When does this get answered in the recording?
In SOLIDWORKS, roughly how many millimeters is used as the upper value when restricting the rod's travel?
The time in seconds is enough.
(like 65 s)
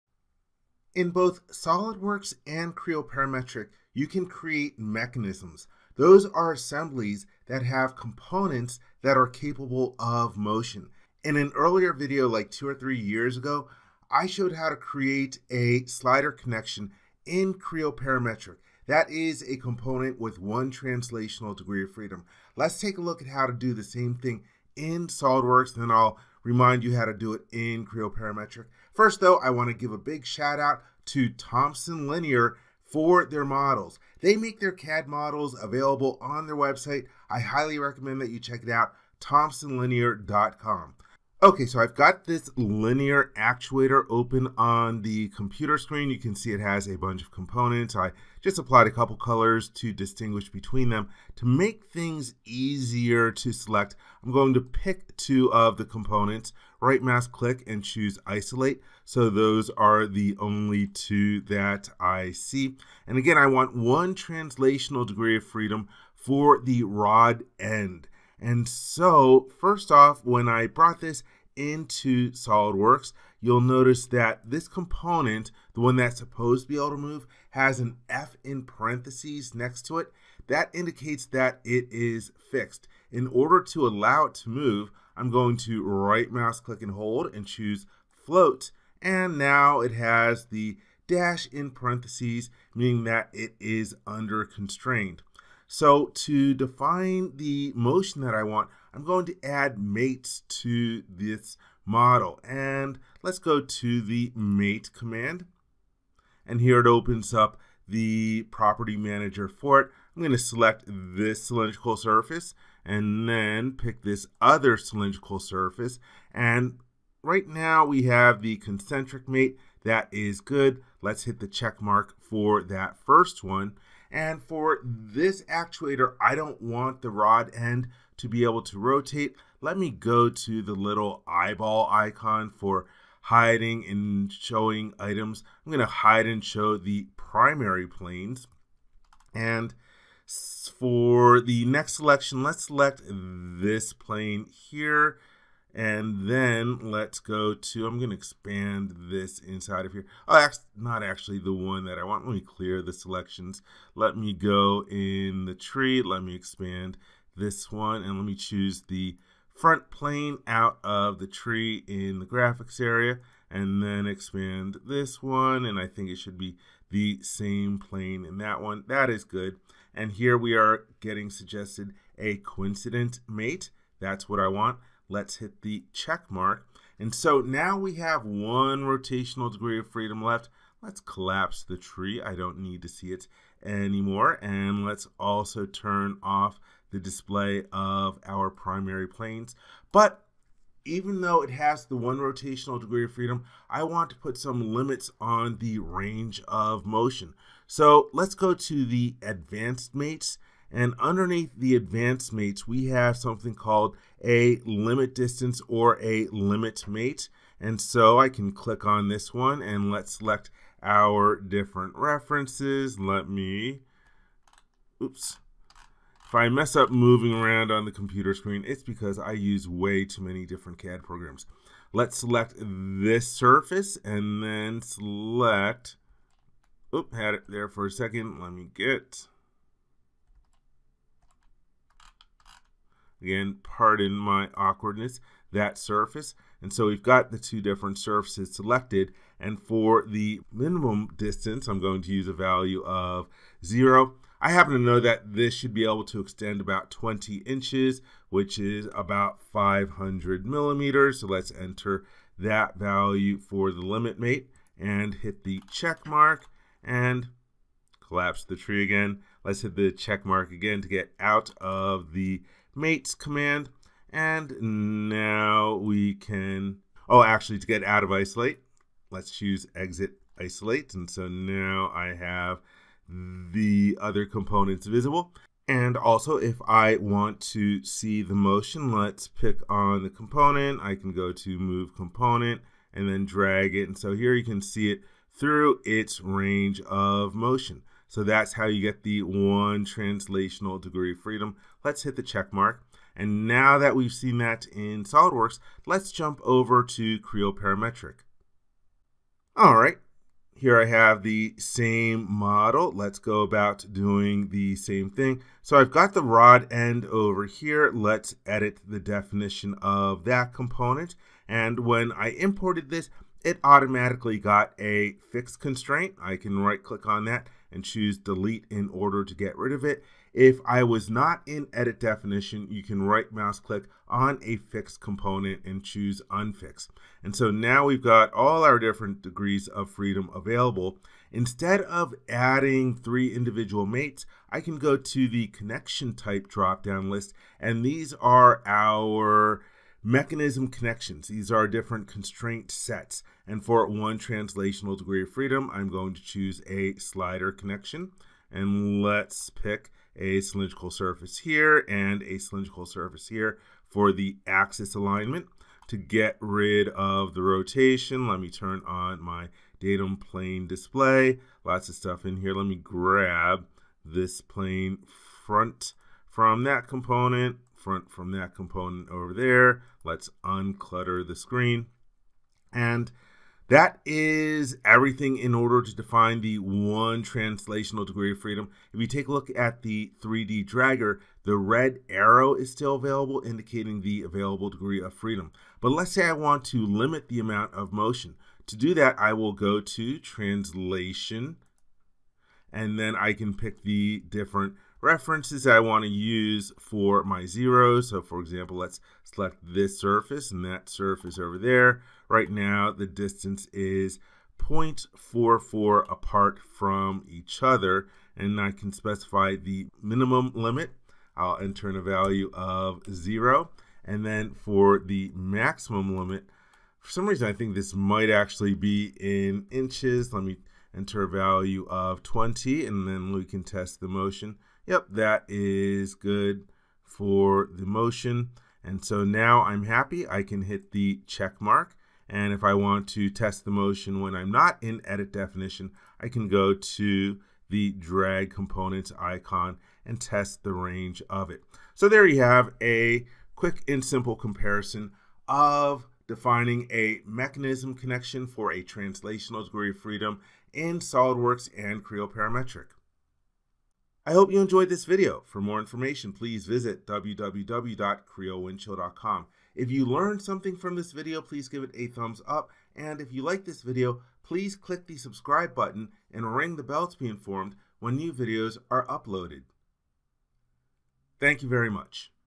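249 s.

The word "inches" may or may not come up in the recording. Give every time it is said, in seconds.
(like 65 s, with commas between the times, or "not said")
247 s, 419 s.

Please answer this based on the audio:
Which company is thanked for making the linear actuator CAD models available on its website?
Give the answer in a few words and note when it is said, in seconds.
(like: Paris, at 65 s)
Thomson Linear, at 31 s.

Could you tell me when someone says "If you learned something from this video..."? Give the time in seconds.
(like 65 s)
459 s.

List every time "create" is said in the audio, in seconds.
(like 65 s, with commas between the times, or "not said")
4 s, 14 s.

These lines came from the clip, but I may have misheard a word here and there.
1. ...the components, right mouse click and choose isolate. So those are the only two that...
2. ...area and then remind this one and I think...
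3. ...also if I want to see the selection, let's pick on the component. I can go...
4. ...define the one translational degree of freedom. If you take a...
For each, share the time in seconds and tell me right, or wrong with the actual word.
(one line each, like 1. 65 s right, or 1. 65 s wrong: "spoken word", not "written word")
1. 55 s right
2. 162 s wrong: "expand", not "remind"
3. 275 s wrong: "motion", not "selection"
4. 375 s right.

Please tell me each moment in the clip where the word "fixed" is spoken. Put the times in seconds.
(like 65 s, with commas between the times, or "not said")
82 s, 315 s, 324 s.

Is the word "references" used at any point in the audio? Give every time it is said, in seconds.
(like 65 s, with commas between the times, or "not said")
211 s, 395 s.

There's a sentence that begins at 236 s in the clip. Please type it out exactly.
And so we've got the two different surfaces selected.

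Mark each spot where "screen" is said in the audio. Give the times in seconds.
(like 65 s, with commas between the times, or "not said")
45 s, 218 s, 371 s.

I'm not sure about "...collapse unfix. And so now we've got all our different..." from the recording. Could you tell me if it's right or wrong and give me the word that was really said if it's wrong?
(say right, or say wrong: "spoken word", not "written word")
wrong: "choose", not "collapse".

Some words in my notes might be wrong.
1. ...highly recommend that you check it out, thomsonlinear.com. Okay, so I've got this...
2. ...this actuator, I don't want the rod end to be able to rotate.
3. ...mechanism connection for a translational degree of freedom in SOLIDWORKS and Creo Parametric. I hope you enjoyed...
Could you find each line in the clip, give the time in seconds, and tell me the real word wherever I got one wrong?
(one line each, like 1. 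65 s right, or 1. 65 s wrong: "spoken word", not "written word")
1. 37 s right
2. 124 s right
3. 447 s right.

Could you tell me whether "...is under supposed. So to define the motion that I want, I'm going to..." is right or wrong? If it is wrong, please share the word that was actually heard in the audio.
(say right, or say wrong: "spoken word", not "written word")
wrong: "constrained", not "supposed".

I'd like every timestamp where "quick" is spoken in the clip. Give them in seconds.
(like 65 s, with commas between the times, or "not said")
443 s.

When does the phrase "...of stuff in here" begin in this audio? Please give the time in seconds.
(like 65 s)
361 s.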